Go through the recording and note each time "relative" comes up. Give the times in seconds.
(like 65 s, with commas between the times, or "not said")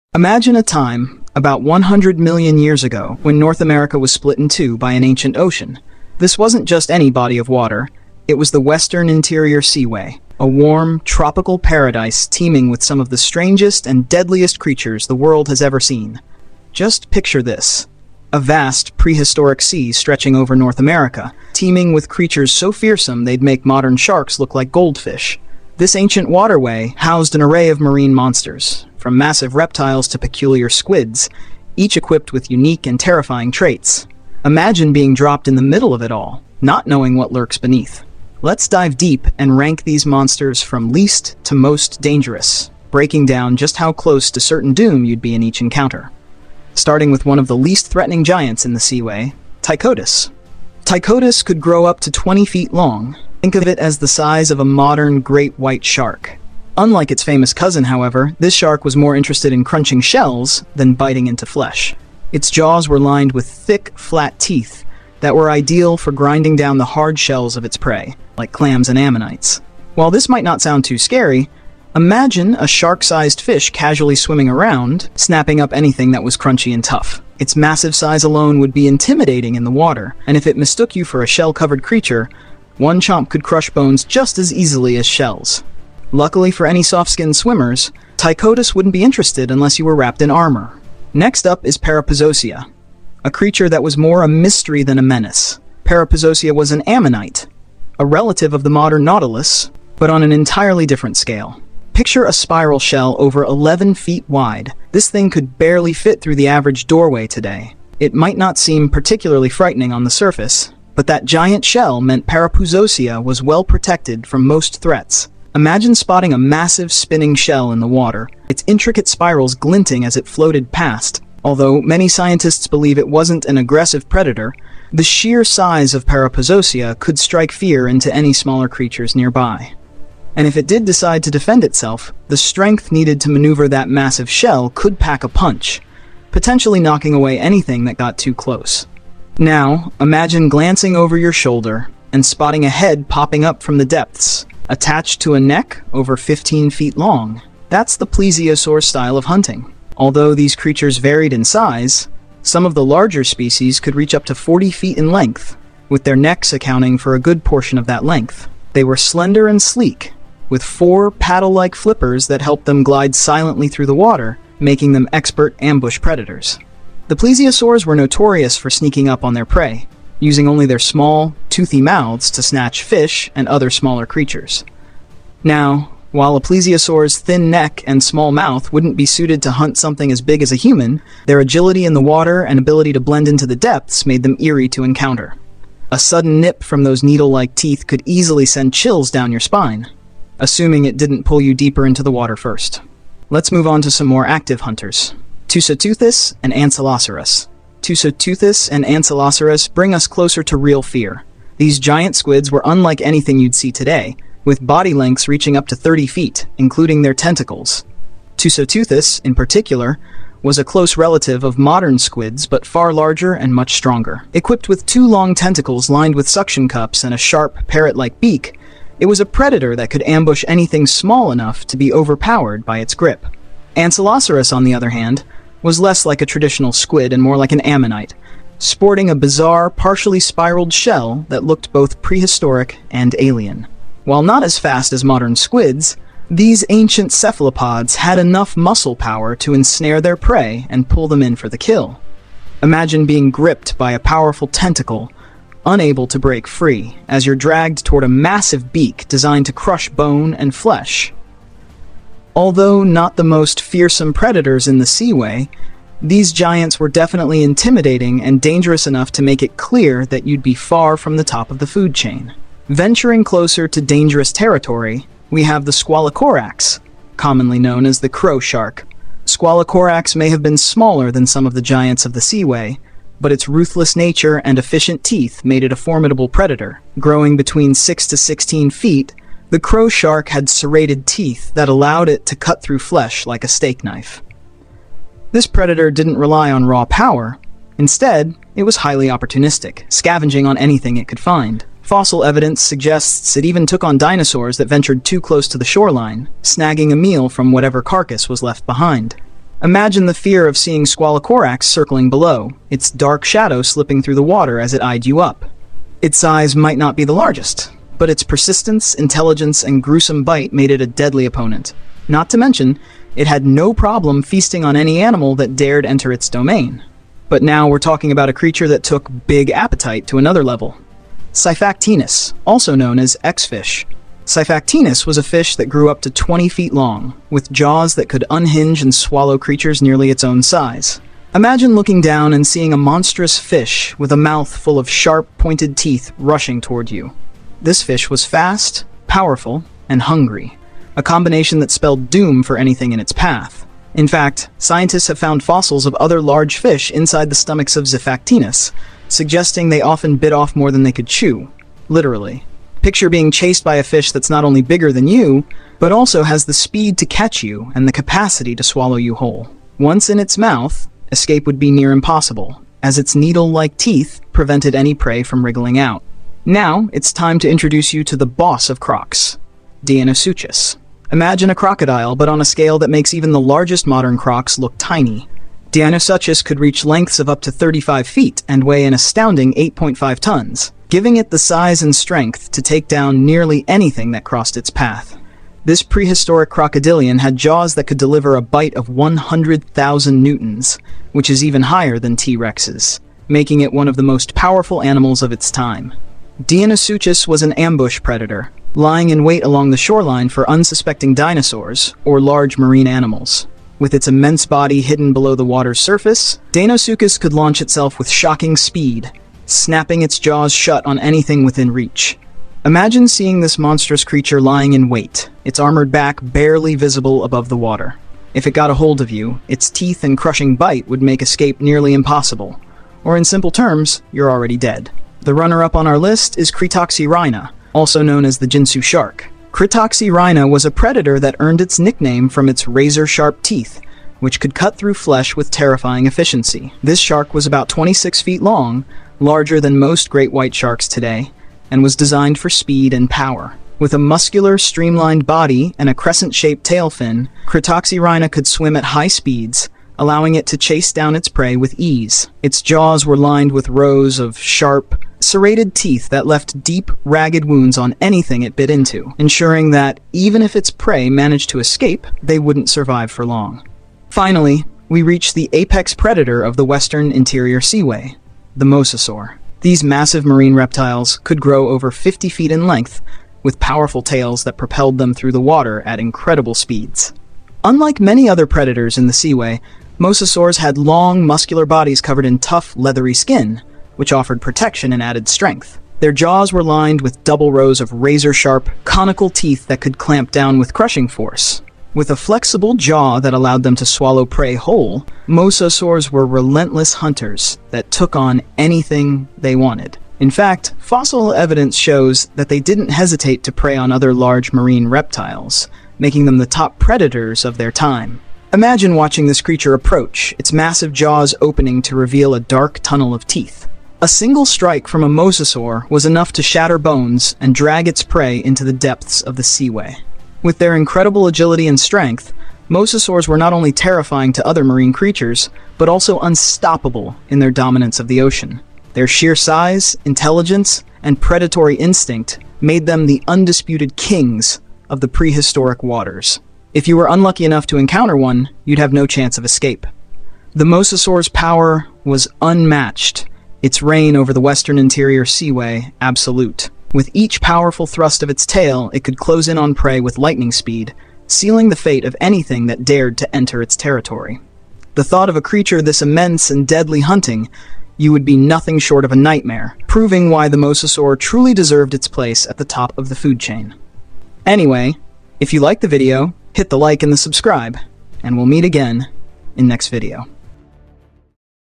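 98 s, 210 s.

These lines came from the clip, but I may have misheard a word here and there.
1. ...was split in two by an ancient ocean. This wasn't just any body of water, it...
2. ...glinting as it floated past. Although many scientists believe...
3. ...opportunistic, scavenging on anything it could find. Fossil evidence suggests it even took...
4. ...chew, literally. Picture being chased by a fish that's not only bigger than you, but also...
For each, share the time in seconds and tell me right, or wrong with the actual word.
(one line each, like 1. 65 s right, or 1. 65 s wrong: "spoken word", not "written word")
1. 3 s right
2. 119 s right
3. 289 s right
4. 351 s right.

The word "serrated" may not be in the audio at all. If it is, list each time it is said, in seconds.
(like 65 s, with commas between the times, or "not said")
280 s, 455 s.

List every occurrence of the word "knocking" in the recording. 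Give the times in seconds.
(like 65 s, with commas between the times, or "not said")
136 s.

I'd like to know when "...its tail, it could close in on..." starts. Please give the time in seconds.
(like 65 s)
548 s.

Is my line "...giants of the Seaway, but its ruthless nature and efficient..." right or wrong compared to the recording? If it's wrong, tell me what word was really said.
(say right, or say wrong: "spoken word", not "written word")
right.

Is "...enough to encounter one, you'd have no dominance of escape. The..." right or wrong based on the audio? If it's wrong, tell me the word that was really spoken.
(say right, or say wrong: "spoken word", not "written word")
wrong: "chance", not "dominance".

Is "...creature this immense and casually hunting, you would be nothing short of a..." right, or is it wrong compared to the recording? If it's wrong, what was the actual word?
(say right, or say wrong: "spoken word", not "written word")
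wrong: "deadly", not "casually".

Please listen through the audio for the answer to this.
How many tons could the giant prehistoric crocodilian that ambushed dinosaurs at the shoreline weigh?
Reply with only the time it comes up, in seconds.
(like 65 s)
379 s.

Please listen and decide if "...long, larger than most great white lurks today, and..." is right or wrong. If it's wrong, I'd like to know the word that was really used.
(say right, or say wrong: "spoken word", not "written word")
wrong: "sharks", not "lurks".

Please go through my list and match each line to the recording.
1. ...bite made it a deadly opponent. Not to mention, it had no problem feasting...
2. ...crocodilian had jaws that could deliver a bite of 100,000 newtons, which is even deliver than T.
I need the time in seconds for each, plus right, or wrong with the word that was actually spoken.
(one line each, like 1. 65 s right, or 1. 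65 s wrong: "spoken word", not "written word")
1. 310 s right
2. 386 s wrong: "higher", not "deliver".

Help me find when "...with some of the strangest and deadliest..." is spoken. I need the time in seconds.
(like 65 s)
12 s.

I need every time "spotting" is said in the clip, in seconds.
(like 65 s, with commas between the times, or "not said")
115 s, 142 s.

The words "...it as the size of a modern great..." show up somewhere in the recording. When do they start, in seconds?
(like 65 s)
53 s.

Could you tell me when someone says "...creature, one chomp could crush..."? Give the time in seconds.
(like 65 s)
81 s.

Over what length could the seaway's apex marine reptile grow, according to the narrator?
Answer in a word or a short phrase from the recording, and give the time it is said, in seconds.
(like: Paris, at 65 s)
over 50 feet, at 471 s.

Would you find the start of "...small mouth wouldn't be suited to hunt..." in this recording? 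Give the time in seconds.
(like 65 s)
178 s.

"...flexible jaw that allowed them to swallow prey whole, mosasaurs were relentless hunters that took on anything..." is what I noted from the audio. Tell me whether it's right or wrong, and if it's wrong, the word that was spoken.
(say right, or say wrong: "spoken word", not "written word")
right.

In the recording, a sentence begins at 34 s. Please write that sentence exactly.
Imagine being dropped in the middle of it all, not knowing what lurks beneath.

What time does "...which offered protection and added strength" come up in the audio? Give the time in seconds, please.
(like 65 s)
483 s.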